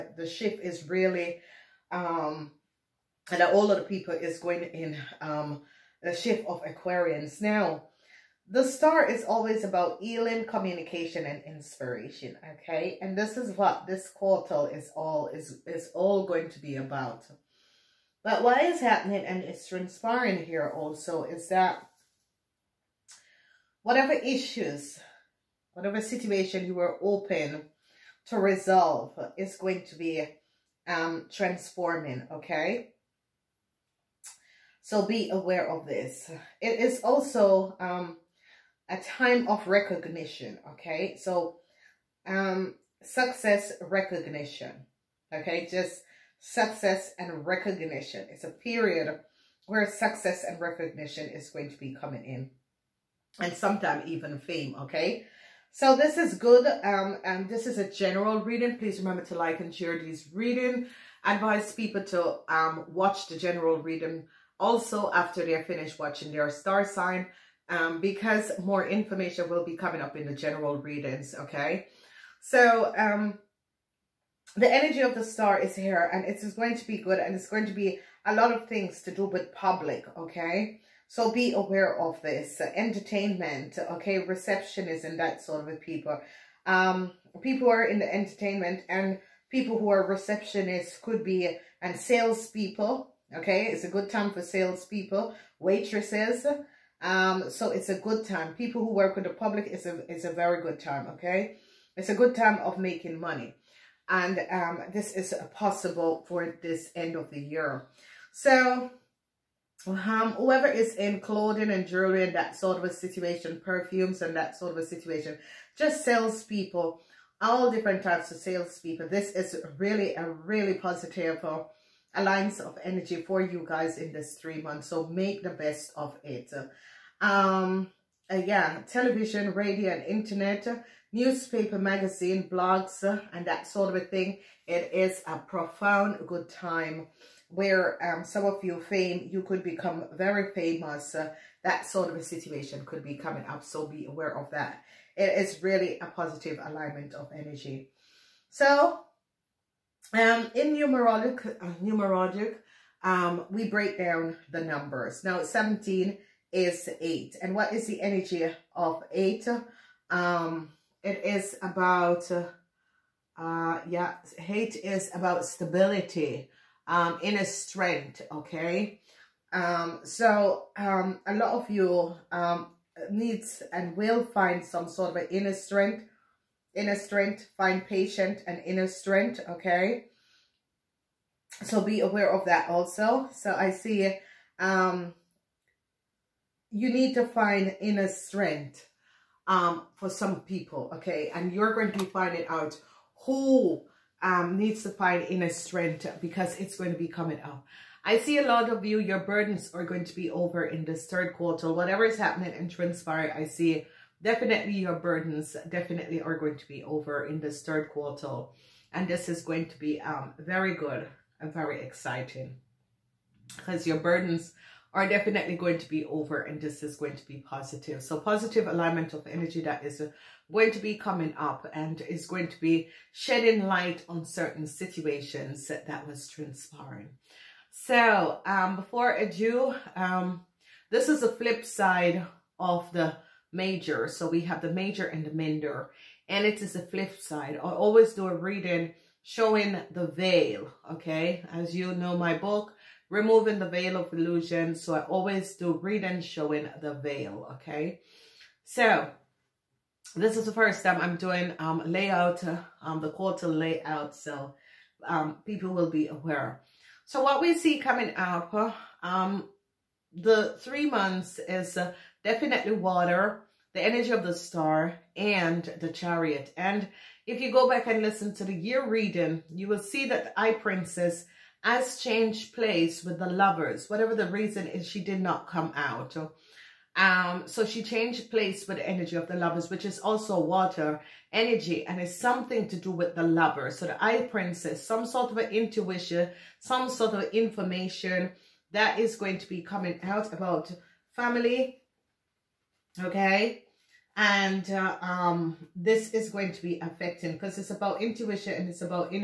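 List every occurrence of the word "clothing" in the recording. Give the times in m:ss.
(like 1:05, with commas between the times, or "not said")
1:51.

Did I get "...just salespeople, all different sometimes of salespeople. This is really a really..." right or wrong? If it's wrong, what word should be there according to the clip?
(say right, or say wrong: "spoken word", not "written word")
wrong: "types", not "sometimes".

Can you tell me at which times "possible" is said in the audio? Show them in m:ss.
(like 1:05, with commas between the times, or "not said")
1:45.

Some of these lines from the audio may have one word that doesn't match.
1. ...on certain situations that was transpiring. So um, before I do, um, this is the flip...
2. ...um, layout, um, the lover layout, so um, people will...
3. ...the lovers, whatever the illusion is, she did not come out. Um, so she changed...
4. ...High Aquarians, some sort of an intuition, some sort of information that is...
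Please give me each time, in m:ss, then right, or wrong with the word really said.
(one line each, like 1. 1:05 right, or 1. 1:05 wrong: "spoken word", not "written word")
1. 3:44 right
2. 4:11 wrong: "quarter", not "lover"
3. 4:33 wrong: "reason", not "illusion"
4. 4:43 wrong: "Priestess", not "Aquarians".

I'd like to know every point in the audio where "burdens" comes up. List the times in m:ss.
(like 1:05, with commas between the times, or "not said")
3:19, 3:24, 3:33.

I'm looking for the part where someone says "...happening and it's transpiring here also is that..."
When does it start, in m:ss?
0:18.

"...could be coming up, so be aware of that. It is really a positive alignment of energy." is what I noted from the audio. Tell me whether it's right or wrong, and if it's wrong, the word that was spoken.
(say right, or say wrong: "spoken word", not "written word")
right.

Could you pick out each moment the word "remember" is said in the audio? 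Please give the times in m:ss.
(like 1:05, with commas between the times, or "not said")
0:58.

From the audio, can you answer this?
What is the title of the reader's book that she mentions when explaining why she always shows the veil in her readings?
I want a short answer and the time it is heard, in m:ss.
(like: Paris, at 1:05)
Removing the Veil of Illusion, at 4:03.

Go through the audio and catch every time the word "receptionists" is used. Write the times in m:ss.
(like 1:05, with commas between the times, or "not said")
1:24, 1:30.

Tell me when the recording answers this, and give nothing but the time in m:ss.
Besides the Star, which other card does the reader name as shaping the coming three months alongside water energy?
4:25.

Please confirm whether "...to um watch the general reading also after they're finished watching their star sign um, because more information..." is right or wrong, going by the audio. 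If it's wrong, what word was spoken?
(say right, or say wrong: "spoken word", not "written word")
right.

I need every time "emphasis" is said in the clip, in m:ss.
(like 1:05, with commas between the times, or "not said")
not said.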